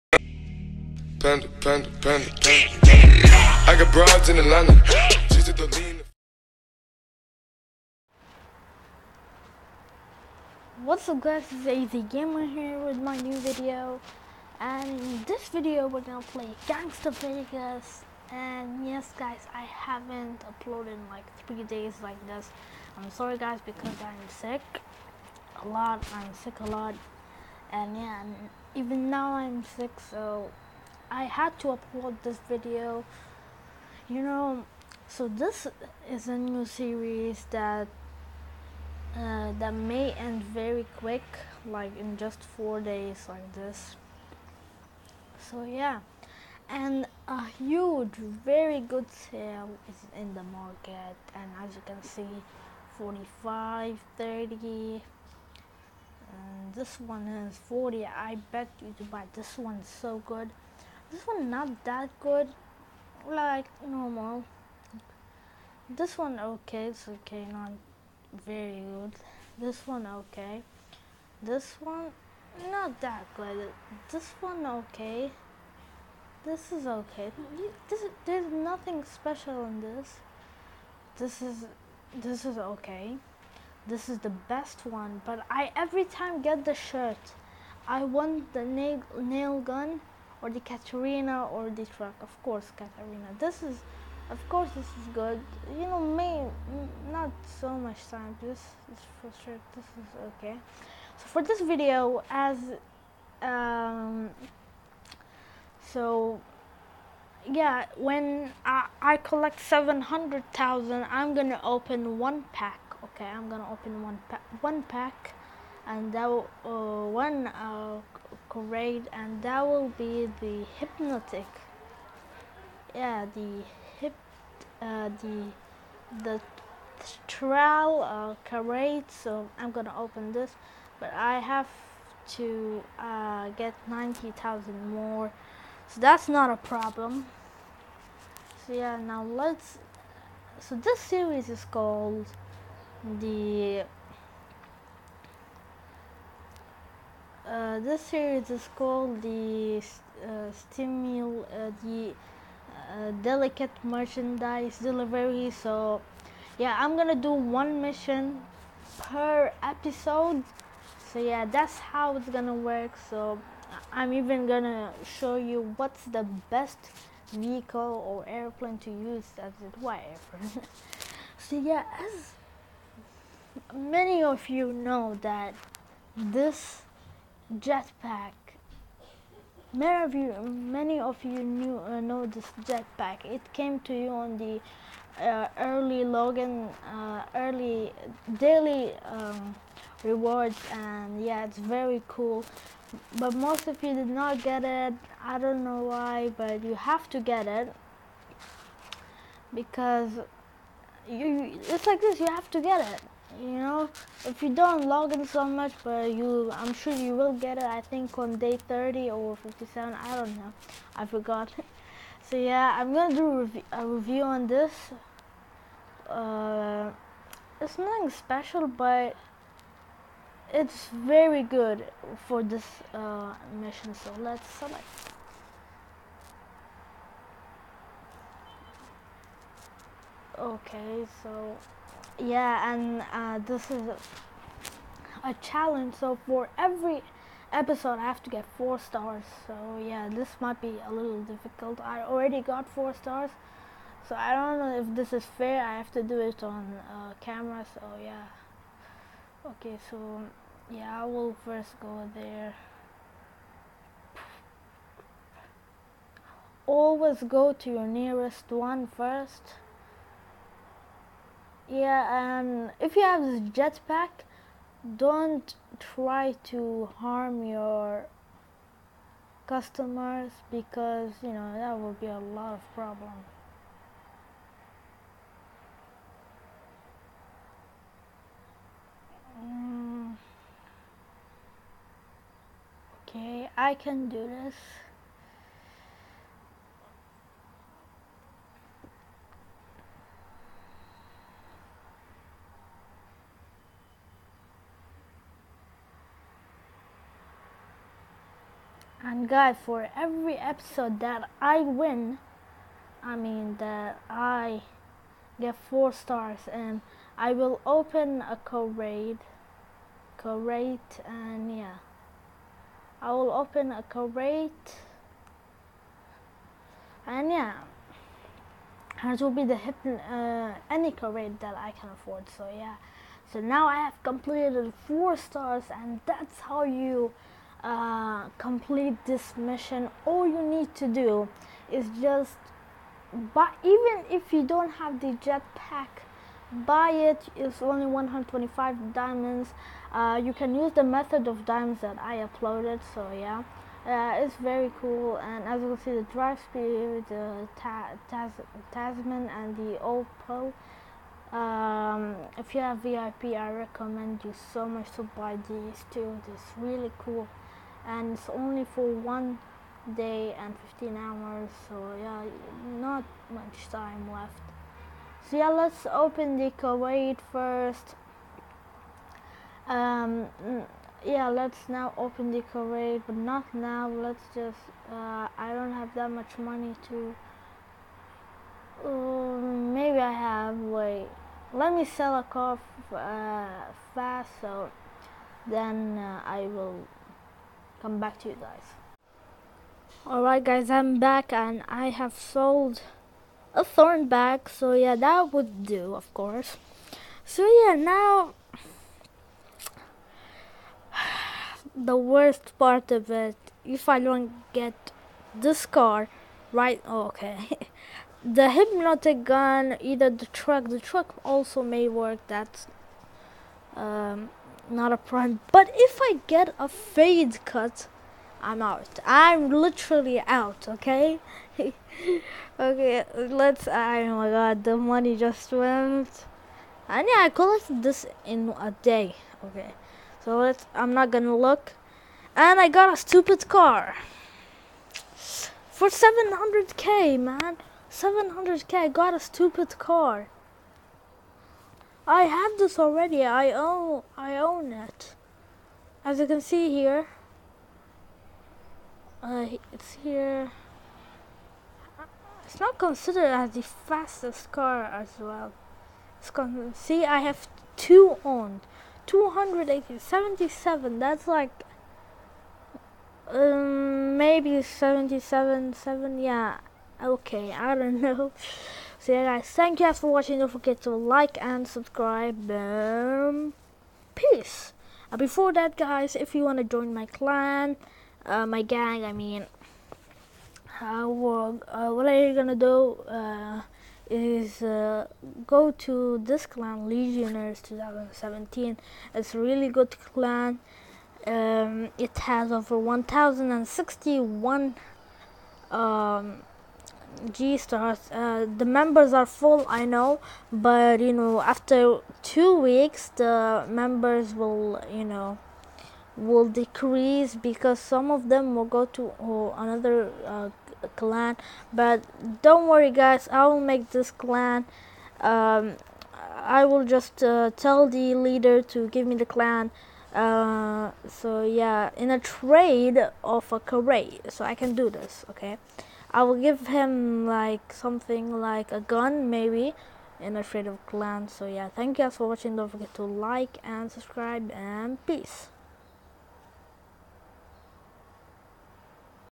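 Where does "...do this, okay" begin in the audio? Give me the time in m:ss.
8:44.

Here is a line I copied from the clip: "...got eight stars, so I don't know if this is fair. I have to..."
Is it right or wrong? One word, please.
wrong.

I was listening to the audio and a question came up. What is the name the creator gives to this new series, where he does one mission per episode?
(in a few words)
delicate merchandise delivery.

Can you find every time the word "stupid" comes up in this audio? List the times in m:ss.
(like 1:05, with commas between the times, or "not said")
7:12, 7:19.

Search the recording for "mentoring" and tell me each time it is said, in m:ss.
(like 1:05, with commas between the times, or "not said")
not said.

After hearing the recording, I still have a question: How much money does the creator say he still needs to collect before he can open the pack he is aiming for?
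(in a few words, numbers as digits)
90,000.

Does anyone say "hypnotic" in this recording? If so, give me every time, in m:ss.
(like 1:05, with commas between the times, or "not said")
2:00, 6:48.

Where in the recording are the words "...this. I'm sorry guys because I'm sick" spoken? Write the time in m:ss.
0:22.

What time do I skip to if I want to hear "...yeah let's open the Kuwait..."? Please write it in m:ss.
6:05.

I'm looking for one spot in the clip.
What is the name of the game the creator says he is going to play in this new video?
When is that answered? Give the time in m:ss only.
0:16.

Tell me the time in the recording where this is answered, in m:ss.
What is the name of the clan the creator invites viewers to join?
8:06.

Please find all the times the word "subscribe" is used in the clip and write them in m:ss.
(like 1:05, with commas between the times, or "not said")
7:51, 8:53.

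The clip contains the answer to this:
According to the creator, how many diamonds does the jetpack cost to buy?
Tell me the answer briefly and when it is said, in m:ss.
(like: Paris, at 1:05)
125, at 5:37.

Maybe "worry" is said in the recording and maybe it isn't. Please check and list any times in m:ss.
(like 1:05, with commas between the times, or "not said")
8:32.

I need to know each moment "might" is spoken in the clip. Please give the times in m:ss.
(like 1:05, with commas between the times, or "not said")
4:00.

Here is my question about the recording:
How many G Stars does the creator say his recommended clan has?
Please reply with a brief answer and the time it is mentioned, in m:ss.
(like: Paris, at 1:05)
1061, at 8:12.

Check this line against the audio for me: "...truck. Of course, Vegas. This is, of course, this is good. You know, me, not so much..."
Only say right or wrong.
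wrong.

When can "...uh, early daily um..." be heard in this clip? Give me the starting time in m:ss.
3:06.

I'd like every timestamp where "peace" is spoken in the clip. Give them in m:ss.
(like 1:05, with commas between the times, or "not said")
7:54, 8:55.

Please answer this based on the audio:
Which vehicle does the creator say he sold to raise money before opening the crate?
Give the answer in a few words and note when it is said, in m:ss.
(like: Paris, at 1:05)
thorn bag, at 6:33.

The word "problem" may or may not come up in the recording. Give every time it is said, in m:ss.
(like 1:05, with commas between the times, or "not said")
2:16, 4:32.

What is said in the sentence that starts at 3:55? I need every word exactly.
So for every episode, I have to get four stars.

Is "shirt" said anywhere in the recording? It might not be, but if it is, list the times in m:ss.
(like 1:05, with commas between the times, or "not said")
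1:26.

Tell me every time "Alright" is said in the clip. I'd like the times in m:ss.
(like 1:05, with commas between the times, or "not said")
6:30.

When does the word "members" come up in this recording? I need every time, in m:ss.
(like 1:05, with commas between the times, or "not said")
8:18, 8:23.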